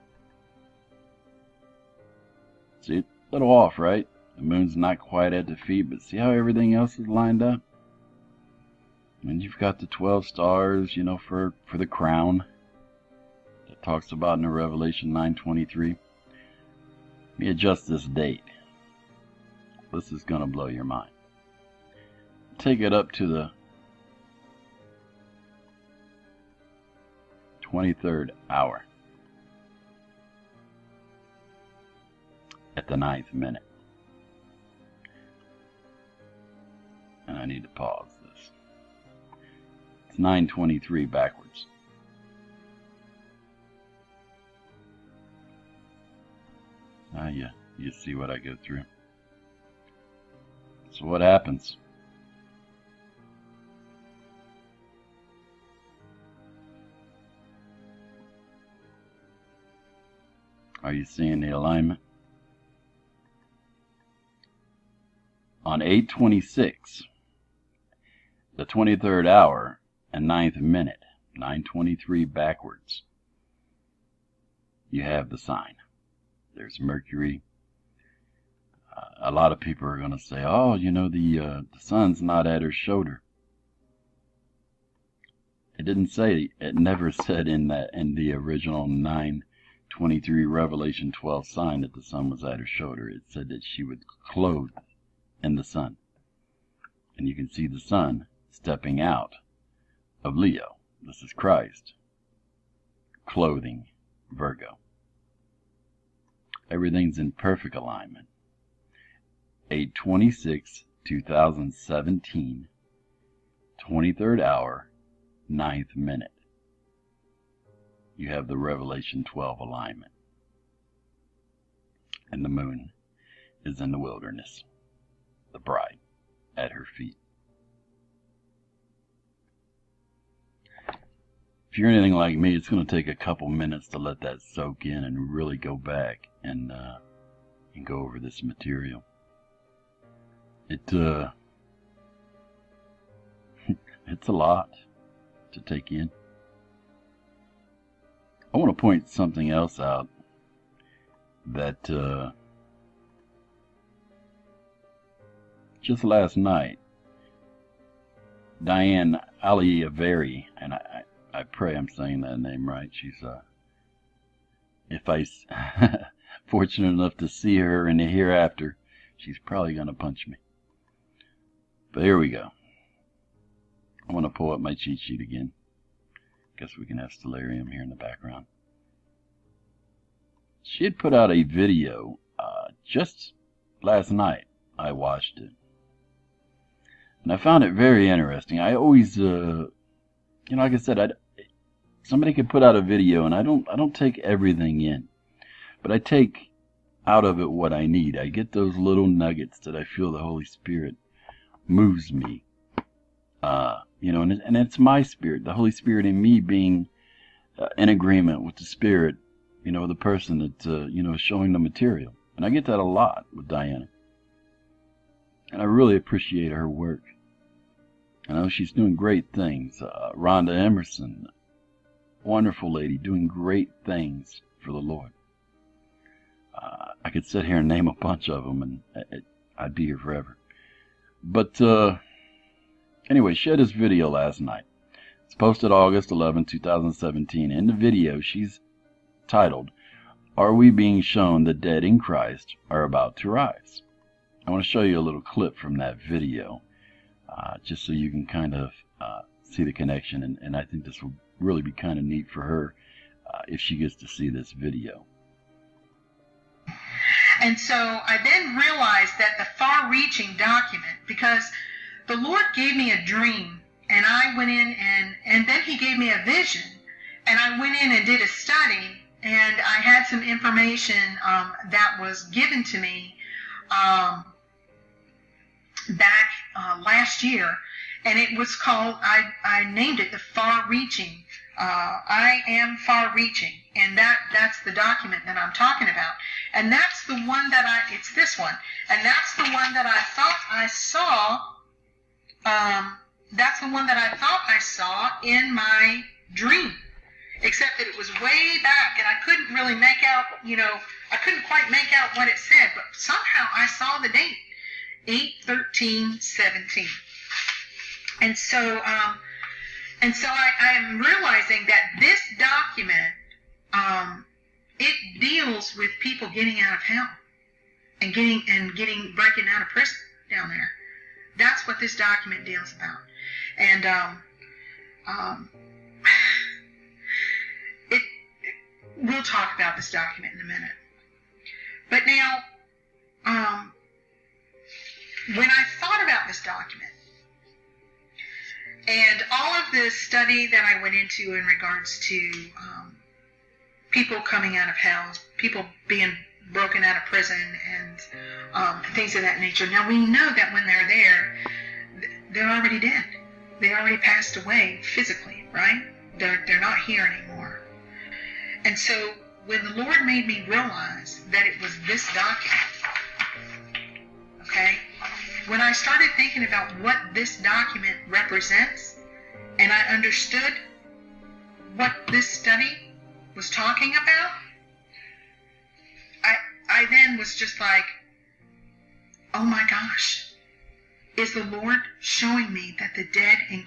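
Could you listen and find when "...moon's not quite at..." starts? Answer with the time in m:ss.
0:04.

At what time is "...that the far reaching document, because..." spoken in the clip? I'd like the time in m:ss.
4:19.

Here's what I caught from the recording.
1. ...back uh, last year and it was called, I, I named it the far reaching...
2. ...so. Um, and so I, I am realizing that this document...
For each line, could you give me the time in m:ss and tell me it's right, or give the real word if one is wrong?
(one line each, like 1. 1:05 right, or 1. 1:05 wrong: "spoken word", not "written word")
1. 4:35 right
2. 5:08 right.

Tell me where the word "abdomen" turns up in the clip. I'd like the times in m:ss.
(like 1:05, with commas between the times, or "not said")
not said.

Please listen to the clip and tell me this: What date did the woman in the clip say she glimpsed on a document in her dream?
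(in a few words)
8/13/17.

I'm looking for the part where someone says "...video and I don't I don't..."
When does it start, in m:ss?
3:12.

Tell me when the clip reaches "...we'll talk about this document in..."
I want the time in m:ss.
5:29.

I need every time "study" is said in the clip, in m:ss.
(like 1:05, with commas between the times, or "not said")
4:28, 5:39, 6:12.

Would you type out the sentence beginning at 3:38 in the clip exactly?
I know she's doing great things.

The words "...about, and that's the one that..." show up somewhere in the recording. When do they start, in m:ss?
4:45.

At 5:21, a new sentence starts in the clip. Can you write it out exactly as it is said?
That's what this document deals about.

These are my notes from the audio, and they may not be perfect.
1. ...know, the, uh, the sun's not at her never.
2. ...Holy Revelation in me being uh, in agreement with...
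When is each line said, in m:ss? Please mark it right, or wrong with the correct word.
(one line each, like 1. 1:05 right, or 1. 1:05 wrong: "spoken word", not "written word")
1. 1:20 wrong: "shoulder", not "never"
2. 3:25 wrong: "Spirit", not "Revelation".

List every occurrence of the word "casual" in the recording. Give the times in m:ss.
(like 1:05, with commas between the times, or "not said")
not said.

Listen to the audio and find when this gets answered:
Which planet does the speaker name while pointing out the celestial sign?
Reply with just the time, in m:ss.
1:16.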